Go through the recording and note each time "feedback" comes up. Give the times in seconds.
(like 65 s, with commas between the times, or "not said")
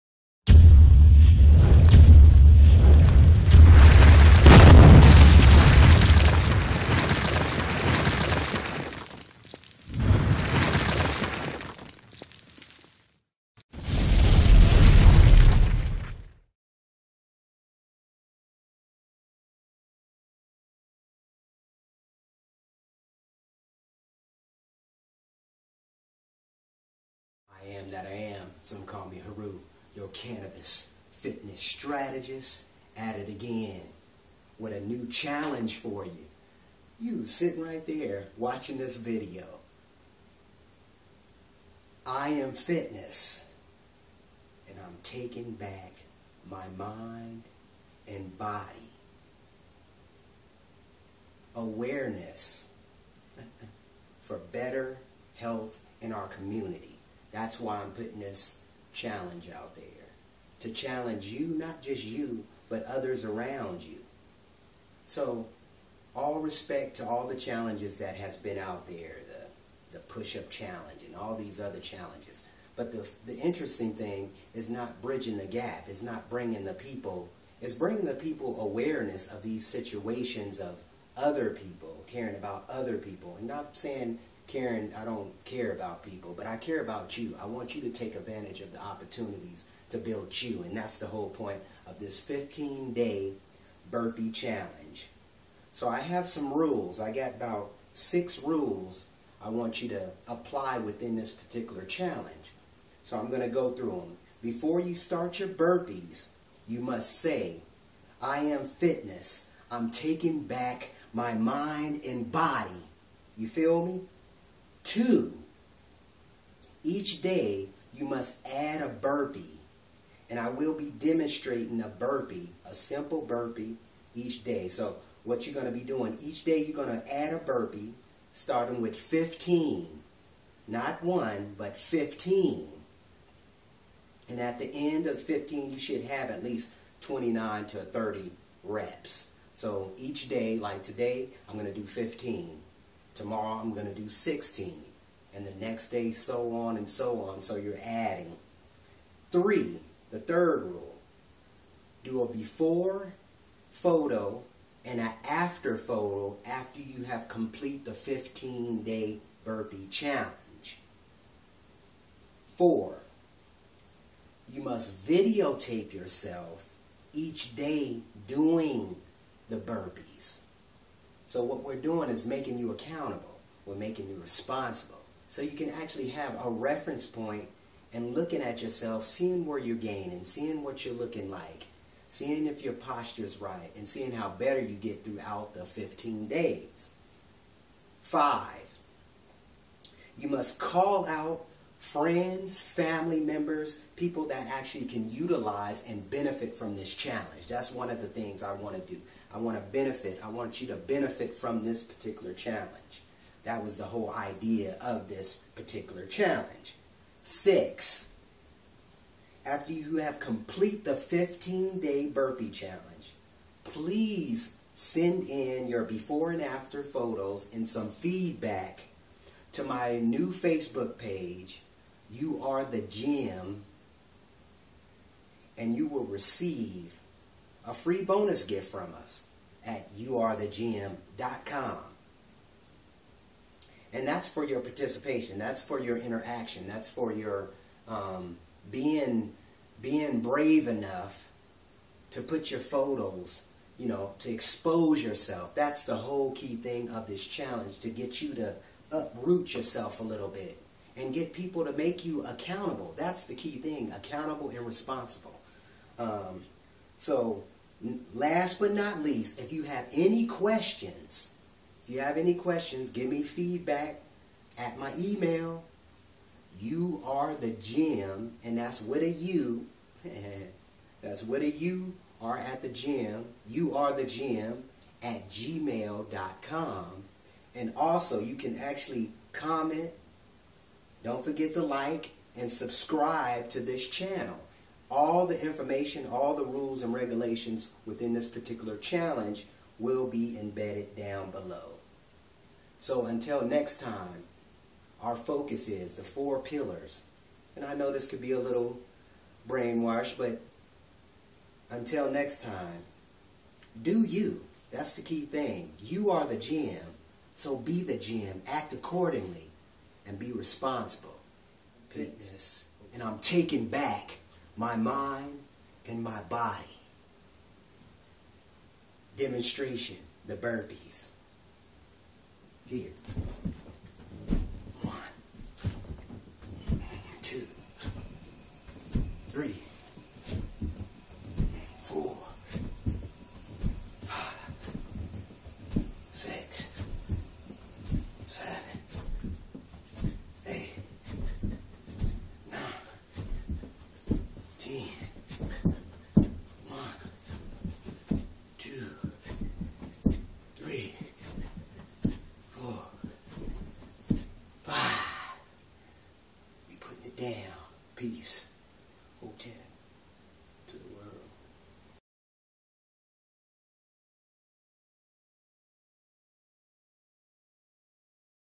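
217 s, 263 s.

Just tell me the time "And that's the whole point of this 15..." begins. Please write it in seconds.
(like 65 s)
90 s.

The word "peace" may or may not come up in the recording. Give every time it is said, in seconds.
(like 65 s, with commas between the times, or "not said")
311 s, 357 s.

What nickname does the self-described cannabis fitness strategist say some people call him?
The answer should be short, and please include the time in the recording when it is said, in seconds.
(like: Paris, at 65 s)
Haru, at 29 s.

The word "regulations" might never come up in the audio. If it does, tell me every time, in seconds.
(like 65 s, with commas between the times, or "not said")
286 s.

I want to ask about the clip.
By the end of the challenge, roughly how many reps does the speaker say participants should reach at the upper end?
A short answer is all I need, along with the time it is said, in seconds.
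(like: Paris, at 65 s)
30, at 137 s.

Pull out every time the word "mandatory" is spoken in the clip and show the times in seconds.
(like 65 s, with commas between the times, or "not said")
not said.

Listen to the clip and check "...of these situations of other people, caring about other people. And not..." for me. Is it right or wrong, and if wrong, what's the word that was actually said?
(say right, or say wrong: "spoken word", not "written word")
right.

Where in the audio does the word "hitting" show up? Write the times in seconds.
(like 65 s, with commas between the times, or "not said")
not said.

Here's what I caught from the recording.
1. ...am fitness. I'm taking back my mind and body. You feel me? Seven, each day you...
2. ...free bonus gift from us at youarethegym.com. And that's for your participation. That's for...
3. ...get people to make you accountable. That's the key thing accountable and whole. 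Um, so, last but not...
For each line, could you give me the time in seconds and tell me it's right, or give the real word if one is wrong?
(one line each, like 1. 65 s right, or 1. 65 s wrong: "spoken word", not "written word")
1. 108 s wrong: "Two", not "Seven"
2. 227 s right
3. 251 s wrong: "responsible", not "whole".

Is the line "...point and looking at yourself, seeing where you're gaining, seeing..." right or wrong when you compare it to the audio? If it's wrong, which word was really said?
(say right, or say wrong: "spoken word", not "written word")
right.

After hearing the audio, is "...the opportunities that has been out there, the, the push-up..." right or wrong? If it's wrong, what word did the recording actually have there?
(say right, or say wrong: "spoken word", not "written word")
wrong: "challenges", not "opportunities".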